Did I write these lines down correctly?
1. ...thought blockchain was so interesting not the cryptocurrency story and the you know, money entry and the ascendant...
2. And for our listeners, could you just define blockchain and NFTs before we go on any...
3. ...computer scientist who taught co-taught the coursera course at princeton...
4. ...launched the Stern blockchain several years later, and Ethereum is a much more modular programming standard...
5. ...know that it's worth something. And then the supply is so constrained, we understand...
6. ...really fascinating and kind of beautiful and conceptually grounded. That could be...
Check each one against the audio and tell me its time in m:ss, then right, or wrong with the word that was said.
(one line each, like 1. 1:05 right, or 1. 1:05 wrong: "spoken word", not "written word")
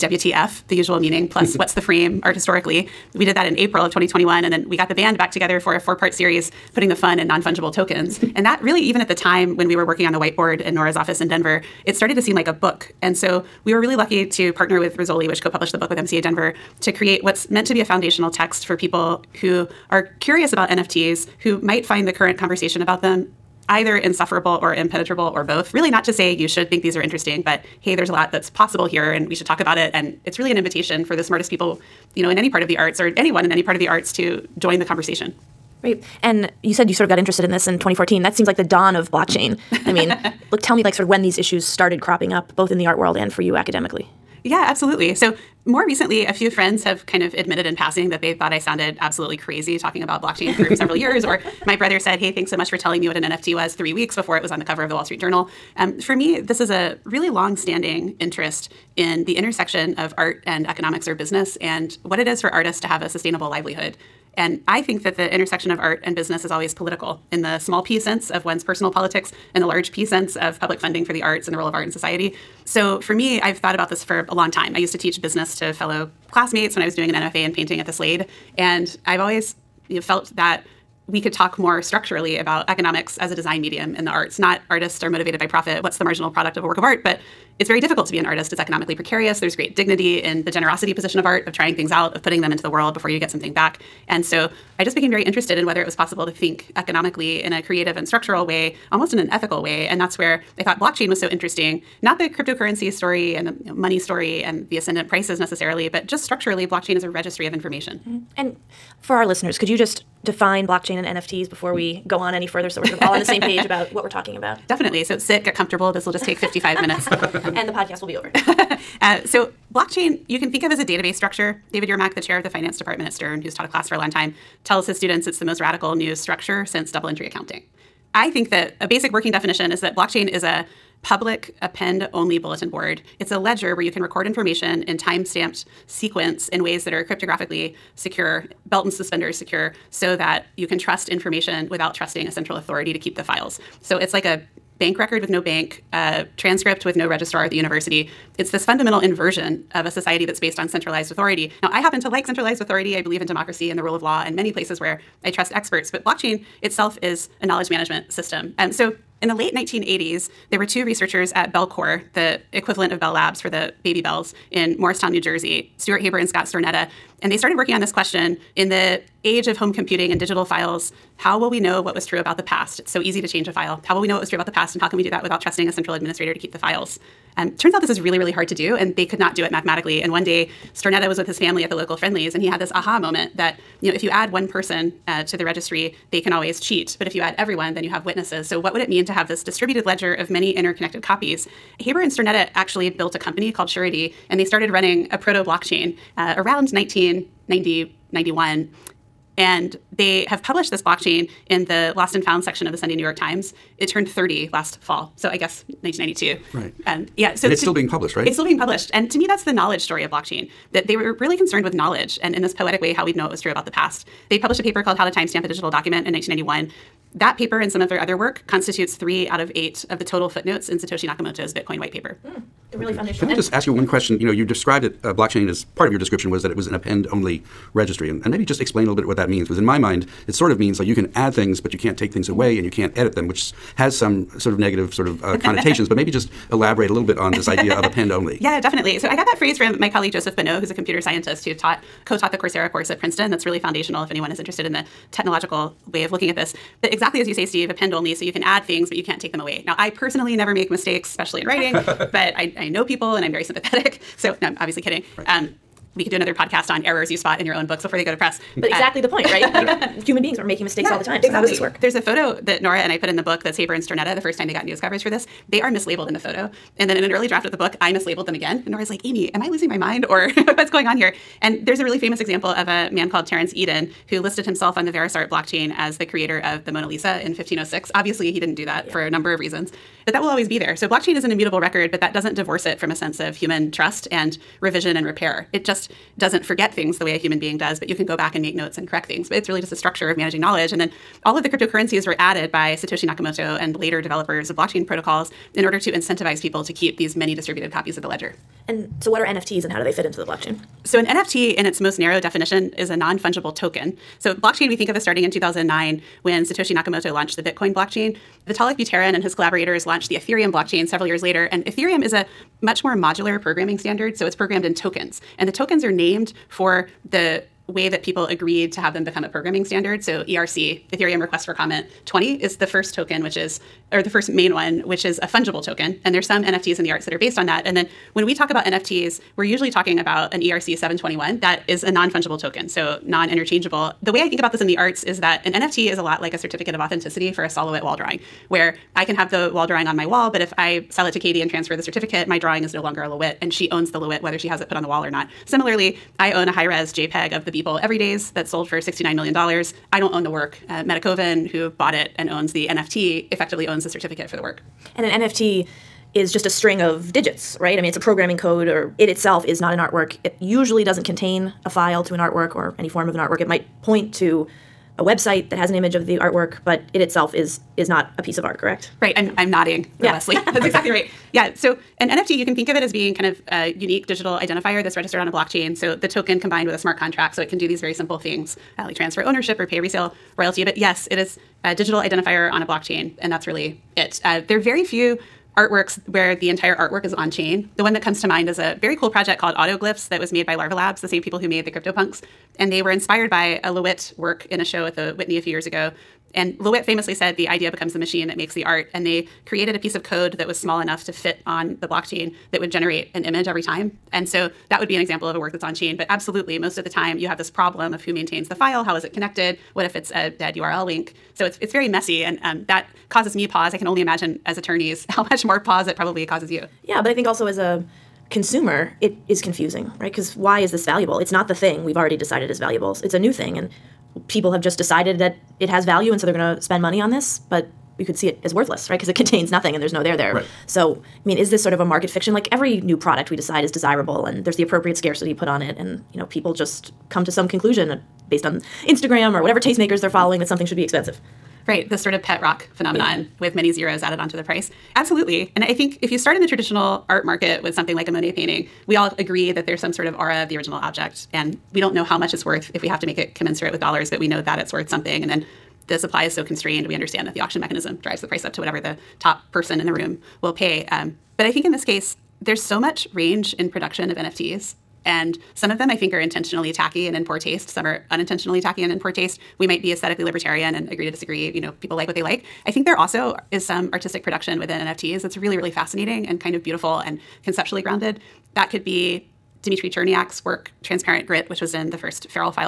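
1. 1:40 wrong: "story", not "entry"
2. 1:48 right
3. 4:00 right
4. 5:09 wrong: "Ethereum", not "Stern"
5. 7:34 right
6. 7:55 right.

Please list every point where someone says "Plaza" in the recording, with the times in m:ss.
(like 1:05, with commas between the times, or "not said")
not said.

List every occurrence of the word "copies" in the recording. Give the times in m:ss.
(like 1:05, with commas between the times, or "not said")
3:11, 4:57.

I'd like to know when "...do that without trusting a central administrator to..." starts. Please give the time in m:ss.
2:55.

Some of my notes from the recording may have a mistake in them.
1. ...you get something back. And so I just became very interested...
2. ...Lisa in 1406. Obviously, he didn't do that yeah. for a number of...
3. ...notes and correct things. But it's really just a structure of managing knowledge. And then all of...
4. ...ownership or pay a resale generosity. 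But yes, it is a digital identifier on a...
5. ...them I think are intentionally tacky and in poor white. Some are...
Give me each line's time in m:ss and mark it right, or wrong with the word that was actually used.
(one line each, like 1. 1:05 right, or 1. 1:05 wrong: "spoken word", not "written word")
1. 1:33 right
2. 4:36 wrong: "1506", not "1406"
3. 4:48 right
4. 6:19 wrong: "royalty", not "generosity"
5. 7:45 wrong: "taste", not "white".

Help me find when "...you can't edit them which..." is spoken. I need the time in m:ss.
3:52.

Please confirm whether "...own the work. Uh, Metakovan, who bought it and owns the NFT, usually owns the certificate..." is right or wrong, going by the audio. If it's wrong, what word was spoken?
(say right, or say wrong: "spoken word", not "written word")
wrong: "effectively", not "usually".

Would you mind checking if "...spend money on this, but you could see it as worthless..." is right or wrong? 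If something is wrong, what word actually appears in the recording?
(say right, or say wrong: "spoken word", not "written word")
right.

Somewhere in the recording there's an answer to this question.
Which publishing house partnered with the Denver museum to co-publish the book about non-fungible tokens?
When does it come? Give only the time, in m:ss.
0:14.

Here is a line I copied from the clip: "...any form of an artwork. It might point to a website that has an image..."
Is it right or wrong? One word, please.
right.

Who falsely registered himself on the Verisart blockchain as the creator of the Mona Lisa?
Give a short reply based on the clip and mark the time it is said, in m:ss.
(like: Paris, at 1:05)
Terence Eden, at 4:33.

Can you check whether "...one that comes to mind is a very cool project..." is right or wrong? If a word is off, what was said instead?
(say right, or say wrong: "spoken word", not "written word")
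right.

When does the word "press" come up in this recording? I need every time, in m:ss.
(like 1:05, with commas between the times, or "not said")
4:18.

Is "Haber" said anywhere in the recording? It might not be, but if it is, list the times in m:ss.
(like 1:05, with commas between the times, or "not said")
2:46, 3:11, 4:23.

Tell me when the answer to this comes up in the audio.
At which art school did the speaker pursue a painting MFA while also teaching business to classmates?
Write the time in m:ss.
1:17.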